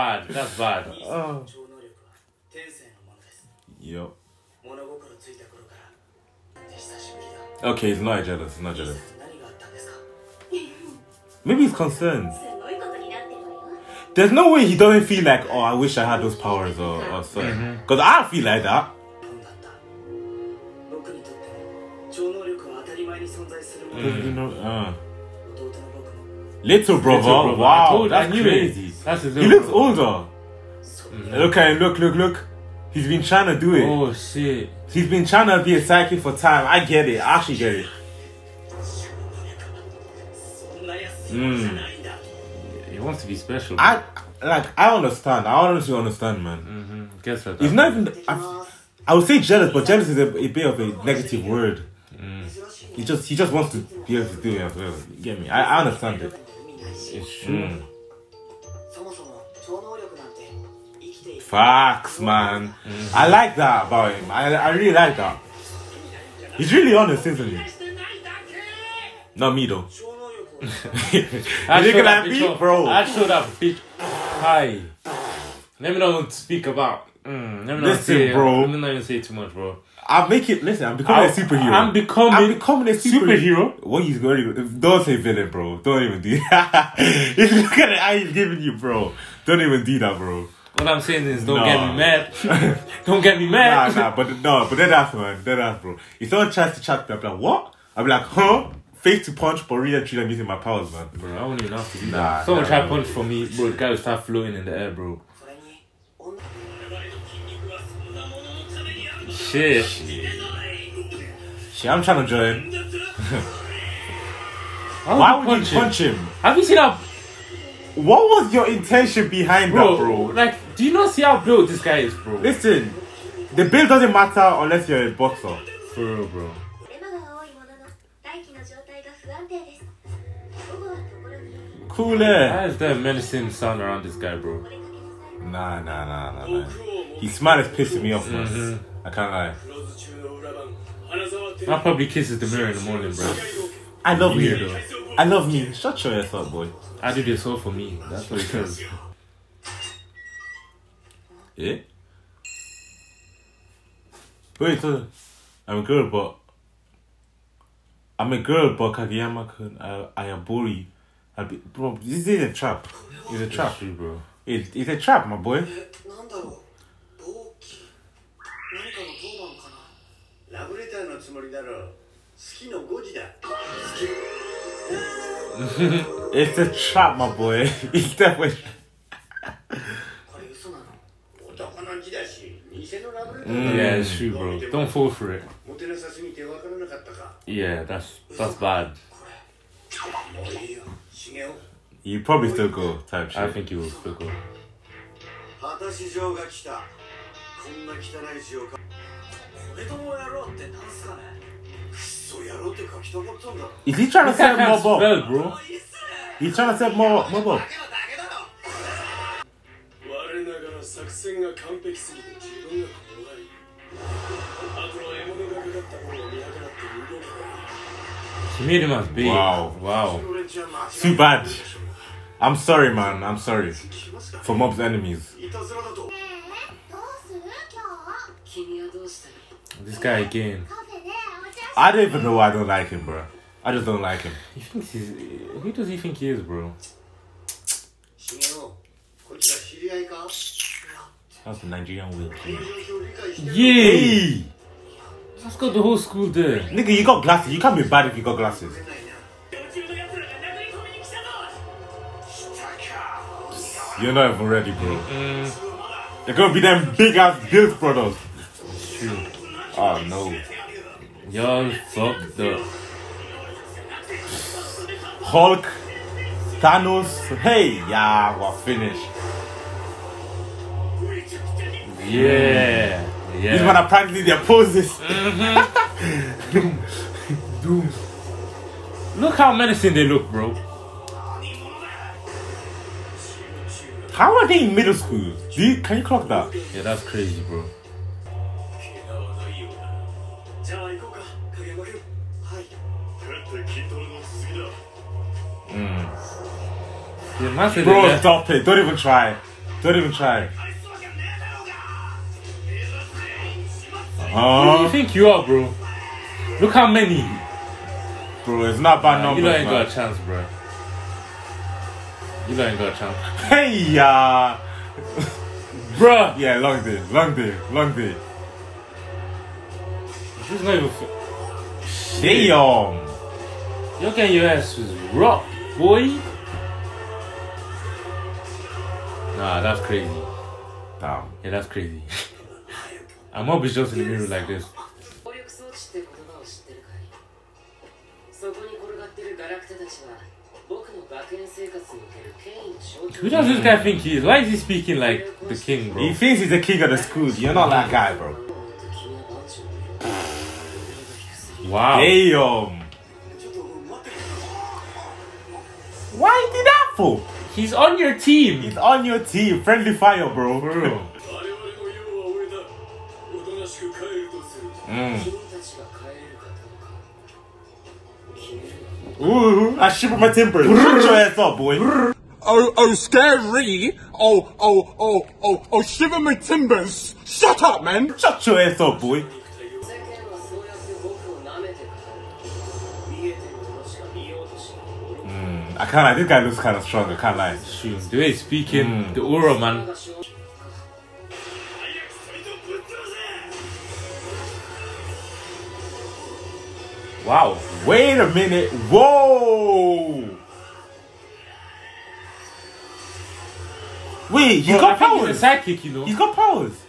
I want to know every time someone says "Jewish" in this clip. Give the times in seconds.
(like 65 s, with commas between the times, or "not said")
not said.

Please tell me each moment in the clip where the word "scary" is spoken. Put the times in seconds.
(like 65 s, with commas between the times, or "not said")
372 s.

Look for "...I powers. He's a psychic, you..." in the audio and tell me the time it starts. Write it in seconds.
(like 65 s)
405 s.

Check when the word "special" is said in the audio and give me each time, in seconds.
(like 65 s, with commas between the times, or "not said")
43 s.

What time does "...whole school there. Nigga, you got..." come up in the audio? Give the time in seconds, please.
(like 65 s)
245 s.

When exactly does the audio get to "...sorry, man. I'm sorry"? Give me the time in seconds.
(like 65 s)
222 s.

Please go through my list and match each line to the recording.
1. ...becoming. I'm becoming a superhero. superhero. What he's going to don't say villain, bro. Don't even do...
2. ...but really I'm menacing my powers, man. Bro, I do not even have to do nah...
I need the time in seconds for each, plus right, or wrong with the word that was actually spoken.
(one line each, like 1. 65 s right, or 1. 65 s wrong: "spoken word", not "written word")
1. 81 s right
2. 99 s wrong: "using", not "menacing".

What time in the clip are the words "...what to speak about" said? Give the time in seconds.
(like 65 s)
76 s.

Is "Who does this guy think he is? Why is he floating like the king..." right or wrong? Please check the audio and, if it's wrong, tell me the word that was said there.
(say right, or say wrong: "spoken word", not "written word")
wrong: "speaking", not "floating".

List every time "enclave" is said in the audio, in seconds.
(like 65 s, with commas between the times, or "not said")
not said.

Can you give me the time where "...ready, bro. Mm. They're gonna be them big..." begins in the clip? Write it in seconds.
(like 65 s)
254 s.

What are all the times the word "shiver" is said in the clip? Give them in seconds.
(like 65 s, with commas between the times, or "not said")
369 s, 375 s.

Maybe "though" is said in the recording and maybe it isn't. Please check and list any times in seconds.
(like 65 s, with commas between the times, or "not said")
69 s, 144 s.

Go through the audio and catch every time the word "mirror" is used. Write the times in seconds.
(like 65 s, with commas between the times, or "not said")
142 s, 334 s.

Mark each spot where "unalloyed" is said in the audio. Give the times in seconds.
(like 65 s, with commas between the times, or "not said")
not said.